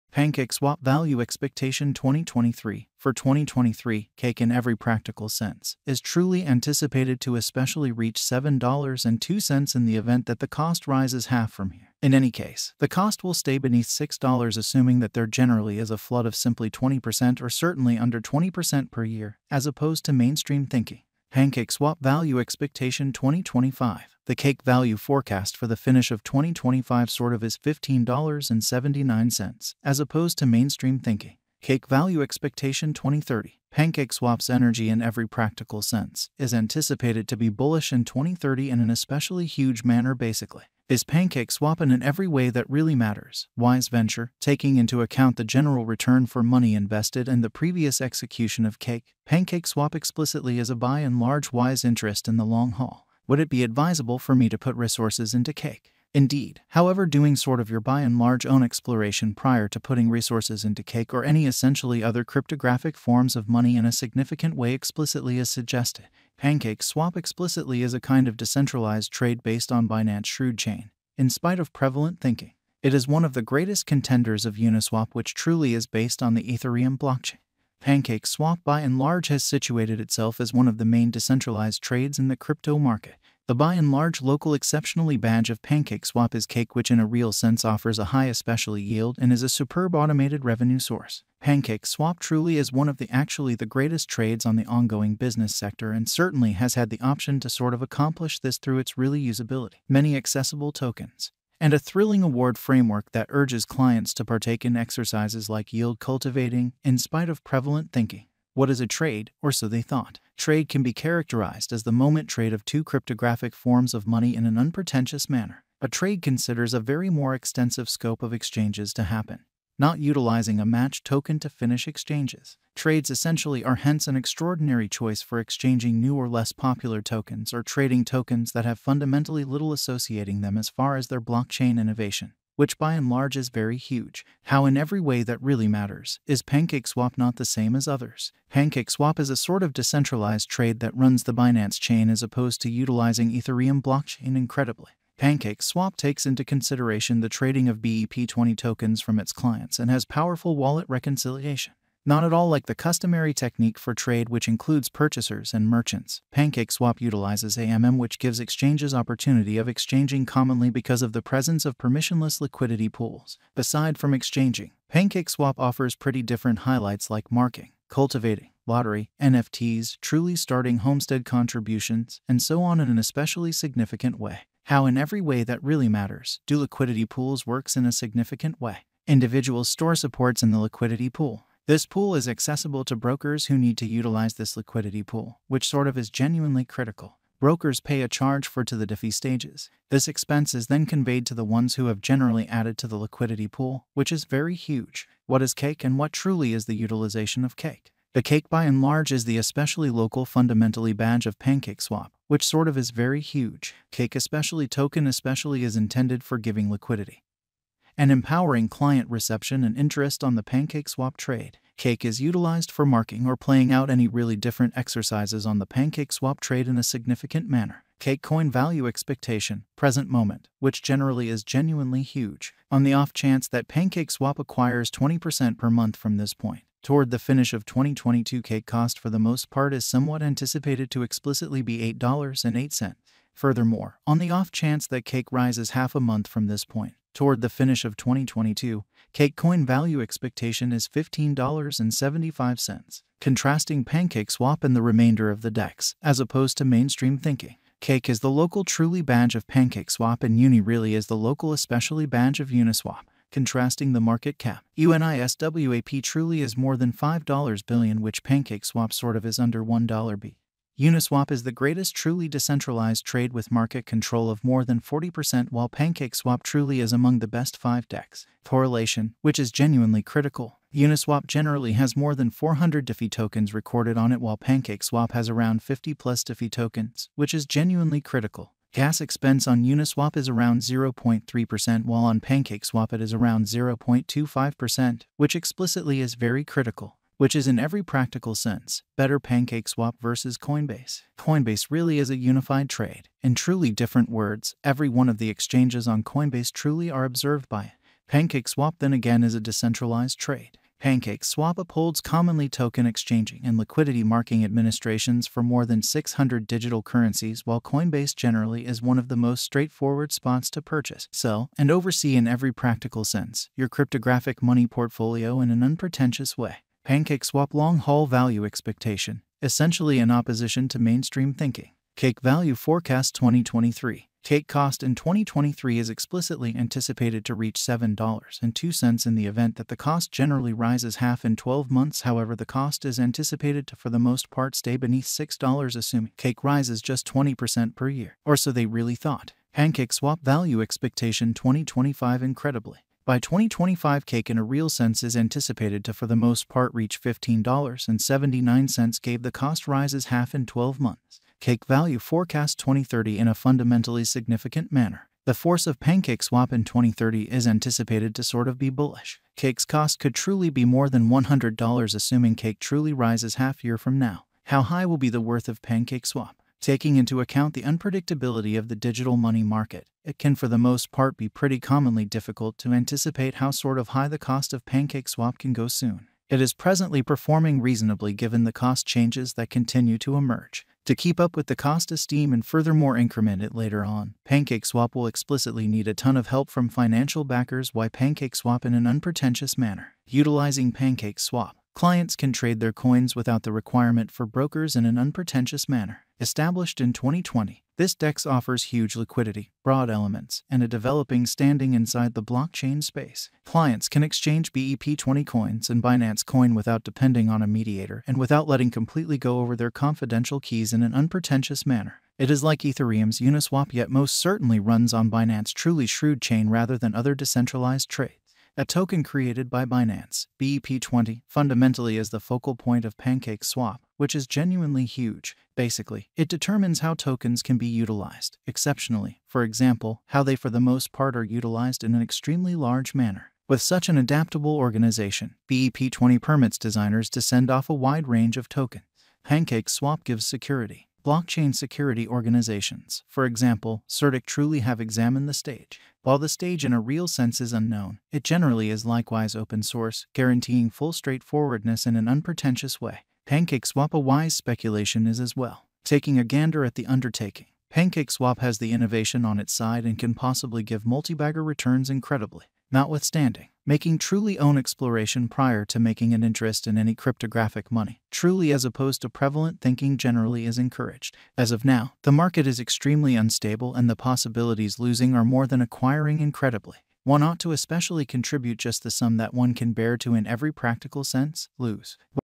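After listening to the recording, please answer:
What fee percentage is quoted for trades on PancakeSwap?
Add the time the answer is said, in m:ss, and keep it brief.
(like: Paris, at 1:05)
0.25%, at 4:43.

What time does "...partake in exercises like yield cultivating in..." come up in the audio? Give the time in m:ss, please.
1:44.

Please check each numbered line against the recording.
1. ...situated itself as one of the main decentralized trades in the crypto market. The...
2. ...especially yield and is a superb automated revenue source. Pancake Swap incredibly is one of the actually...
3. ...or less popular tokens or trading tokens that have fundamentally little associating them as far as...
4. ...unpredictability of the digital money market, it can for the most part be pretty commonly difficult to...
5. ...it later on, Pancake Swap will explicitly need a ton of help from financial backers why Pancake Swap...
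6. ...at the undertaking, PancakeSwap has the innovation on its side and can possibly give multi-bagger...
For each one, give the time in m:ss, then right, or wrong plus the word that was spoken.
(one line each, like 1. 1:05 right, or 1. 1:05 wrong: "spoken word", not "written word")
1. 1:19 right
2. 1:28 wrong: "truly", not "incredibly"
3. 2:06 right
4. 6:07 right
5. 6:23 right
6. 7:36 right.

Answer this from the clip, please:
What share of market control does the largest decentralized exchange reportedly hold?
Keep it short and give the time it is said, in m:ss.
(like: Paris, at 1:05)
more than 40%, at 4:24.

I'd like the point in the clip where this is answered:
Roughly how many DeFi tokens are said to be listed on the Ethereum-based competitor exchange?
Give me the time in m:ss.
4:31.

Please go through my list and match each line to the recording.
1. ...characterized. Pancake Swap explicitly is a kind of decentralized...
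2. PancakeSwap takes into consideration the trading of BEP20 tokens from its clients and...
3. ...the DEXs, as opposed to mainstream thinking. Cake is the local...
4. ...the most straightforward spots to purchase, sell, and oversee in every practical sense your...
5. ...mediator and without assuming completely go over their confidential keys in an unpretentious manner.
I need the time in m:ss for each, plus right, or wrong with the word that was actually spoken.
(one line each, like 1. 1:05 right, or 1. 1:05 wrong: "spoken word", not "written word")
1. 1:05 wrong: "suggested", not "characterized"
2. 2:25 right
3. 4:05 right
4. 5:09 right
5. 6:47 wrong: "letting", not "assuming".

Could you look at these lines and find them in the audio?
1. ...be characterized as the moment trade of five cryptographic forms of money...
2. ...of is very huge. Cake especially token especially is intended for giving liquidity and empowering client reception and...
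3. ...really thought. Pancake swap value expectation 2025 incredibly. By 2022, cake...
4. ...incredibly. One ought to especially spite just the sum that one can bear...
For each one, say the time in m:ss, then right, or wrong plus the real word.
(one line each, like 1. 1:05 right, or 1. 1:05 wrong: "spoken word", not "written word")
1. 1:50 wrong: "two", not "five"
2. 3:22 right
3. 5:38 wrong: "2025", not "2022"
4. 7:56 wrong: "contribute", not "spite".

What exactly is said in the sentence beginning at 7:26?
While the stage in a real sense is unknown, it generally is likewise open source, guaranteeing full straightforwardness in an unpretentious way.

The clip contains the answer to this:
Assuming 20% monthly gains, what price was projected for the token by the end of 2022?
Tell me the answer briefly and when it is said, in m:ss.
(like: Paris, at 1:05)
$8.08, at 3:51.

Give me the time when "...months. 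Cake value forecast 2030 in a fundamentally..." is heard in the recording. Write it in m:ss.
5:50.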